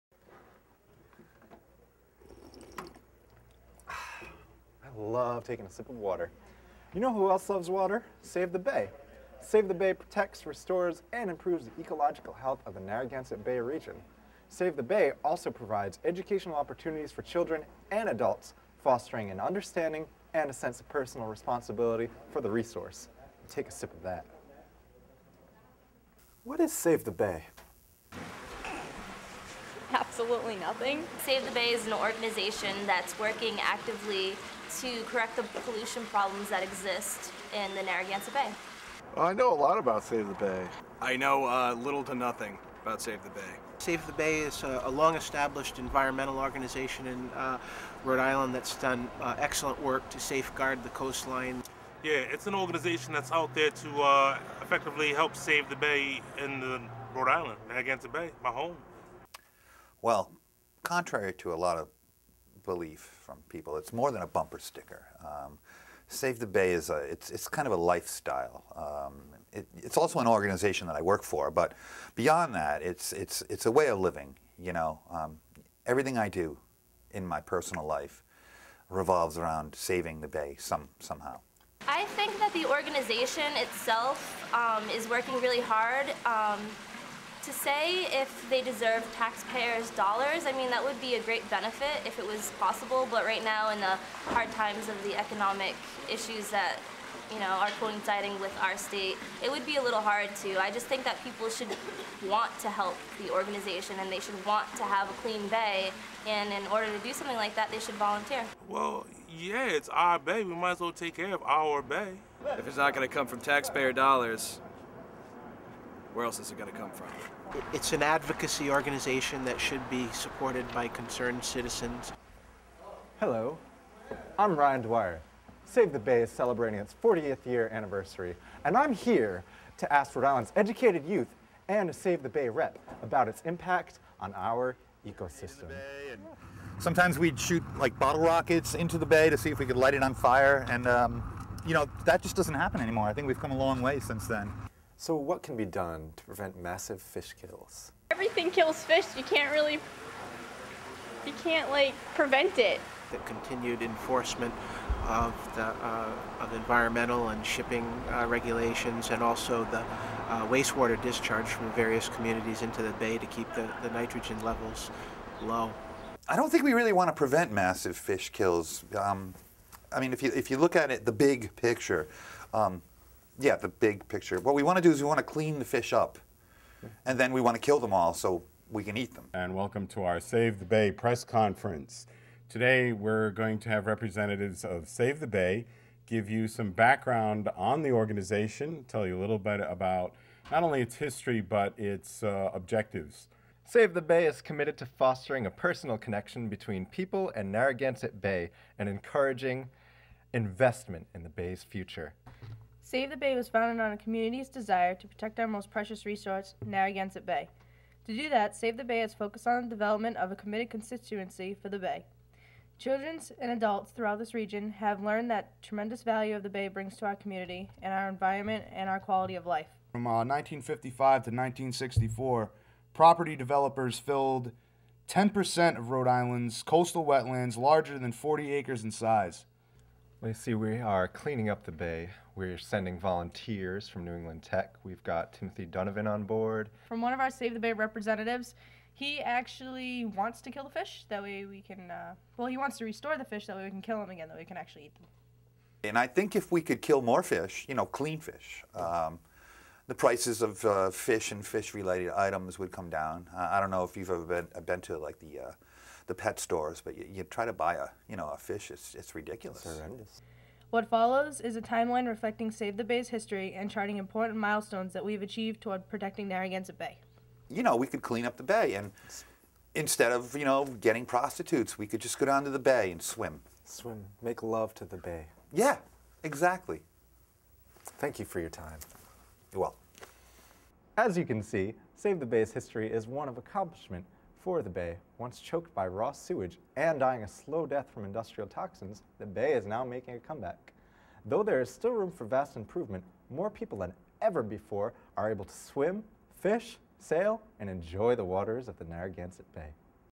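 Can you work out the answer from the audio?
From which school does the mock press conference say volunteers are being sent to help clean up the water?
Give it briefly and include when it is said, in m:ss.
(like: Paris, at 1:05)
New England Tech, at 3:54.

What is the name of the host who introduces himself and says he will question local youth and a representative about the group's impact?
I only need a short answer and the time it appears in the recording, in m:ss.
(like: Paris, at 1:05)
Ryan Dwyer, at 2:04.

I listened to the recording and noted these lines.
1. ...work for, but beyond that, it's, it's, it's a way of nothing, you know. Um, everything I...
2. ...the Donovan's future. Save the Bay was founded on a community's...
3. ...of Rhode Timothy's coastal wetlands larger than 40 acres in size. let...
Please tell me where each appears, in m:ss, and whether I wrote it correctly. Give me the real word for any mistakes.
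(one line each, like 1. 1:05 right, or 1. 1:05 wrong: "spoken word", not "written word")
1. 1:11 wrong: "living", not "nothing"
2. 3:21 wrong: "Bay", not "Donovan"
3. 3:45 wrong: "Island", not "Timothy".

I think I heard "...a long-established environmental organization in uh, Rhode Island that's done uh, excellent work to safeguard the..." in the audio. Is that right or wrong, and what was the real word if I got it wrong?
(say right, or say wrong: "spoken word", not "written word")
right.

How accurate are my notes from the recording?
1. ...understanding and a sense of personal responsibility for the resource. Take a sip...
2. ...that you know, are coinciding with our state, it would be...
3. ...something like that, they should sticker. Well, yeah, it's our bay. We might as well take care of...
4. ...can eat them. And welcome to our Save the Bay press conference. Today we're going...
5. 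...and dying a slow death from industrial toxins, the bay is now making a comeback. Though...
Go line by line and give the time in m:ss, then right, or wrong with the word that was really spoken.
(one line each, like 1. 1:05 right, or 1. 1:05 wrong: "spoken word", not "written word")
1. 0:19 right
2. 1:36 right
3. 1:47 wrong: "volunteer", not "sticker"
4. 2:58 right
5. 4:46 right.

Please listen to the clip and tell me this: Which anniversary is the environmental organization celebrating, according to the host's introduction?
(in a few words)
40th.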